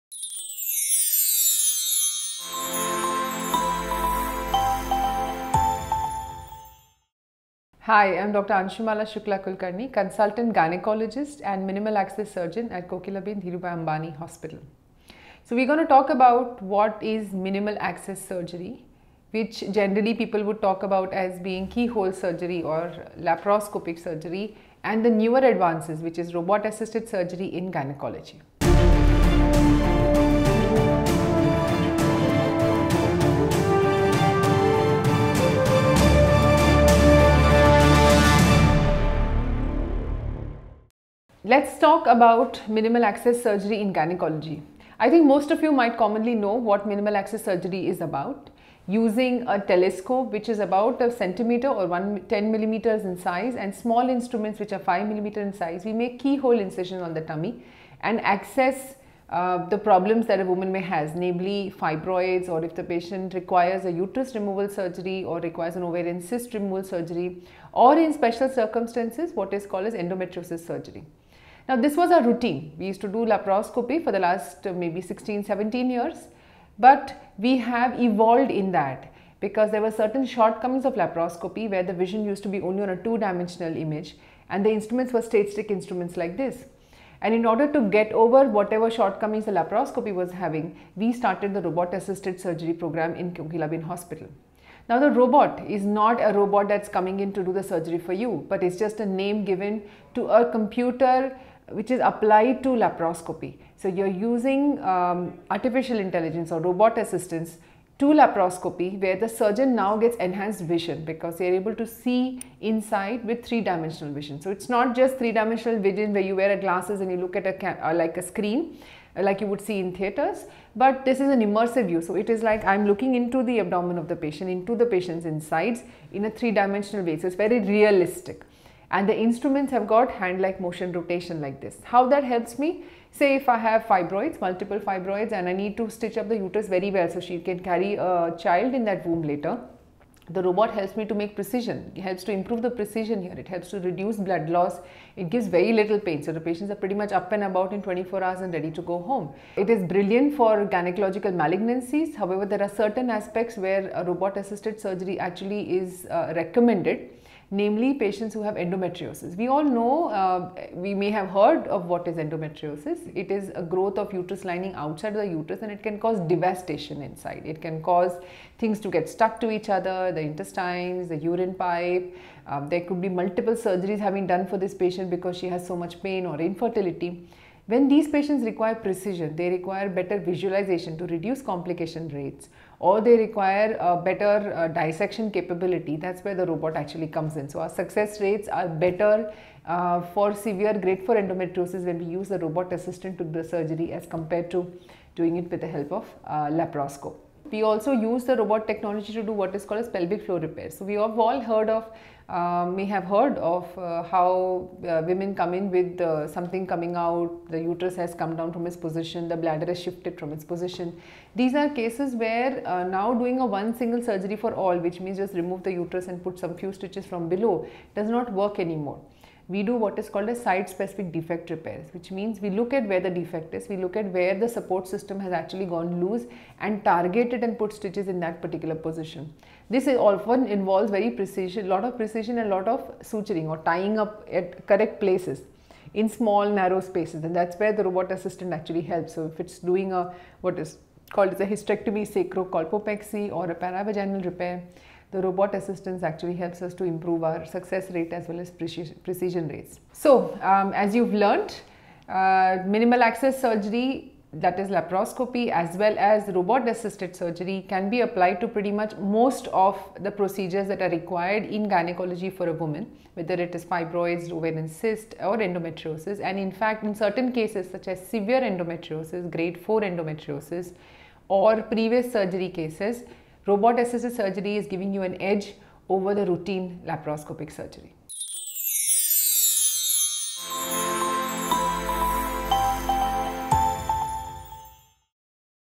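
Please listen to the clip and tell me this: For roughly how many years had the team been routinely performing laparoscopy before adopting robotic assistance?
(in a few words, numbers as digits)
16 to 17 years.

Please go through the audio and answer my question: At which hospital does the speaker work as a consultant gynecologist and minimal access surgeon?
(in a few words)
Kokilaben Dhirubhai Ambani Hospital.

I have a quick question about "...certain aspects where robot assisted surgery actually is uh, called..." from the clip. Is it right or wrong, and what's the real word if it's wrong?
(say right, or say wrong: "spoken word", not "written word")
wrong: "recommended", not "called".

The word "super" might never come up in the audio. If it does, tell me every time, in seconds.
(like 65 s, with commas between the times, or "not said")
not said.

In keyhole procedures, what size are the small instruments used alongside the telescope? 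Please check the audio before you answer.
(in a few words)
5 millimeters.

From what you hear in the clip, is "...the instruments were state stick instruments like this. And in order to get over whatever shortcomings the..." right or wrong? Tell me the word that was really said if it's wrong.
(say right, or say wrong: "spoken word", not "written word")
right.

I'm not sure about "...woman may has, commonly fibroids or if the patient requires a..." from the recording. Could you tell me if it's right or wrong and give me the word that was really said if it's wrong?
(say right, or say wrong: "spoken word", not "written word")
wrong: "namely", not "commonly".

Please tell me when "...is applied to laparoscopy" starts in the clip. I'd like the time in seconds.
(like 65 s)
101 s.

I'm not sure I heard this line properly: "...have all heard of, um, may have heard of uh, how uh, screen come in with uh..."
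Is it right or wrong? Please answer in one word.
wrong.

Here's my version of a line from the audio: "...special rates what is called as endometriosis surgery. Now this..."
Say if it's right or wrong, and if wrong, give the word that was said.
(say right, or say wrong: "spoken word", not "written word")
wrong: "circumstances", not "rates".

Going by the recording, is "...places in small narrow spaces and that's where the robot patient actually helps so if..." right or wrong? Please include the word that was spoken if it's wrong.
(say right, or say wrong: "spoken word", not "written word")
wrong: "assistant", not "patient".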